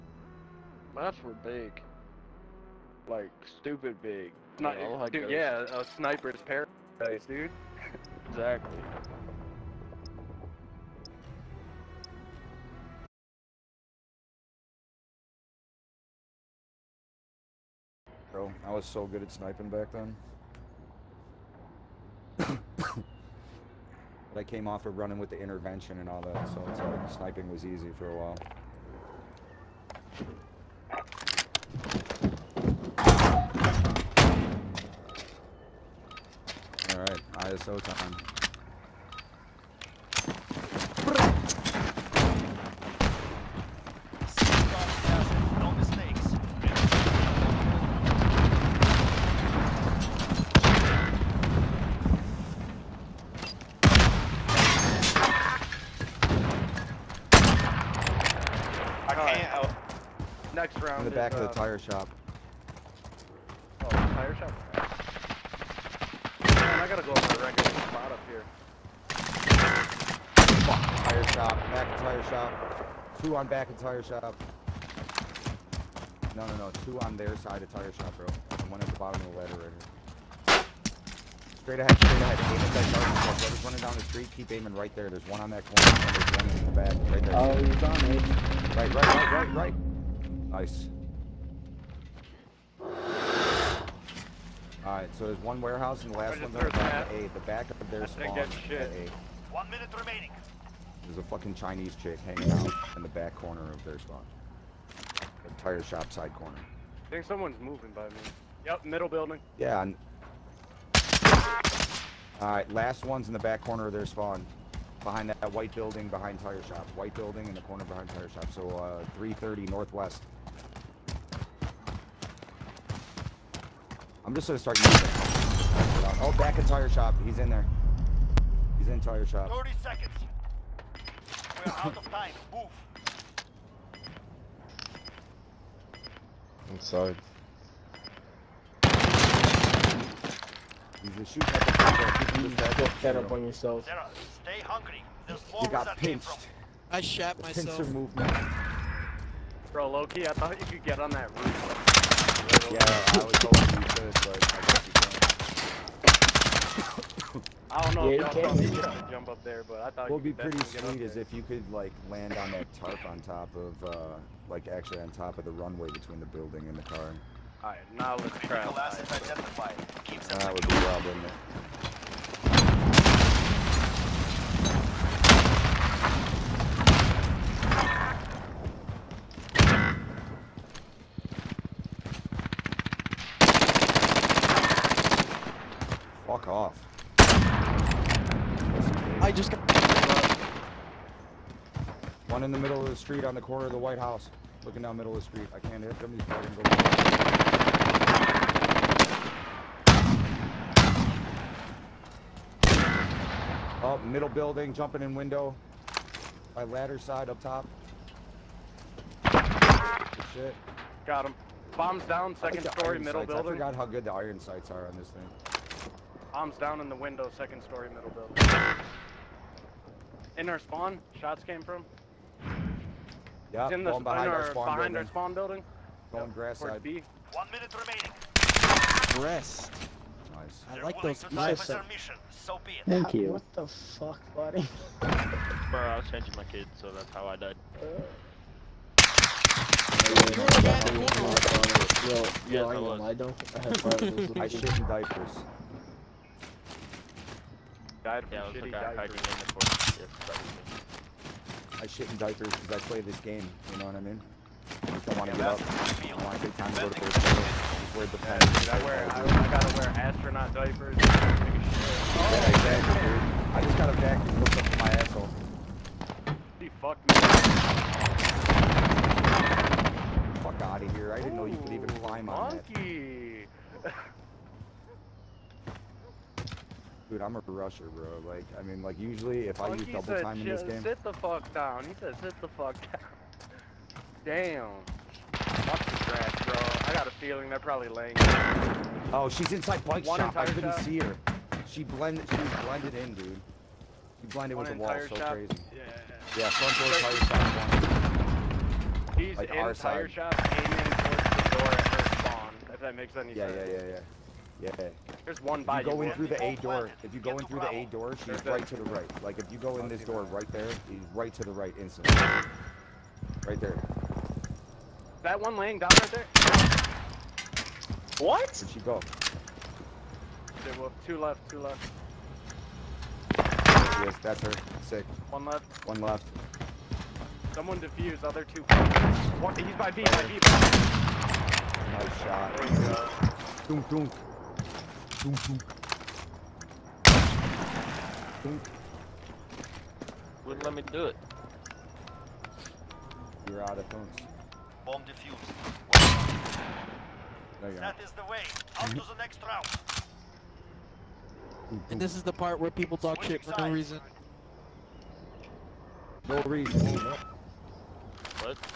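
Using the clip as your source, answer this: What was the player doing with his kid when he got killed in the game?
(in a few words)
changing my kid.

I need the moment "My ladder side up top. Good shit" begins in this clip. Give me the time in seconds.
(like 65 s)
206 s.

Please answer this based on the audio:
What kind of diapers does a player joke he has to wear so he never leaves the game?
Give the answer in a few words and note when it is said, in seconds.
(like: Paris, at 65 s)
astronaut diapers, at 259 s.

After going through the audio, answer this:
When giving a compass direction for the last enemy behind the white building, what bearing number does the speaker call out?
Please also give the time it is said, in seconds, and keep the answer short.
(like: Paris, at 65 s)
330, at 119 s.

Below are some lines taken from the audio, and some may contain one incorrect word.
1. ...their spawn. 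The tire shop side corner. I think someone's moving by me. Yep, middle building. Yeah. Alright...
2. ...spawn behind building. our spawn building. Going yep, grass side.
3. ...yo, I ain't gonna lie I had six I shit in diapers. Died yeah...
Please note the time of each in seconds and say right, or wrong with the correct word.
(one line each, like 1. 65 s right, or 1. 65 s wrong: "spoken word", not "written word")
1. 103 s right
2. 224 s right
3. 242 s wrong: "five", not "six".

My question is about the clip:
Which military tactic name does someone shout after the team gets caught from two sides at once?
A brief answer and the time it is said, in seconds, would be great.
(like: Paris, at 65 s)
Pincer movement, at 147 s.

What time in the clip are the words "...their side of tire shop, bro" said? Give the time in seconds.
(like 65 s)
77 s.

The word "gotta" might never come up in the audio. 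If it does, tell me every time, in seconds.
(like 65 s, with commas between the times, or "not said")
66 s, 259 s.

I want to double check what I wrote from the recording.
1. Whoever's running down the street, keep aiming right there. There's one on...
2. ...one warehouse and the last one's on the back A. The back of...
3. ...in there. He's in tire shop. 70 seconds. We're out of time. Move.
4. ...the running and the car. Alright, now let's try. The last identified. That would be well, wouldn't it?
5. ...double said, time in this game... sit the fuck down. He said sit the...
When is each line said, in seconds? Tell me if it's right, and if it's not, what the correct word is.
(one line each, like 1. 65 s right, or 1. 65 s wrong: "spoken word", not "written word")
1. 83 s right
2. 95 s right
3. 127 s wrong: "30", not "70"
4. 166 s wrong: "building", not "running"
5. 279 s right.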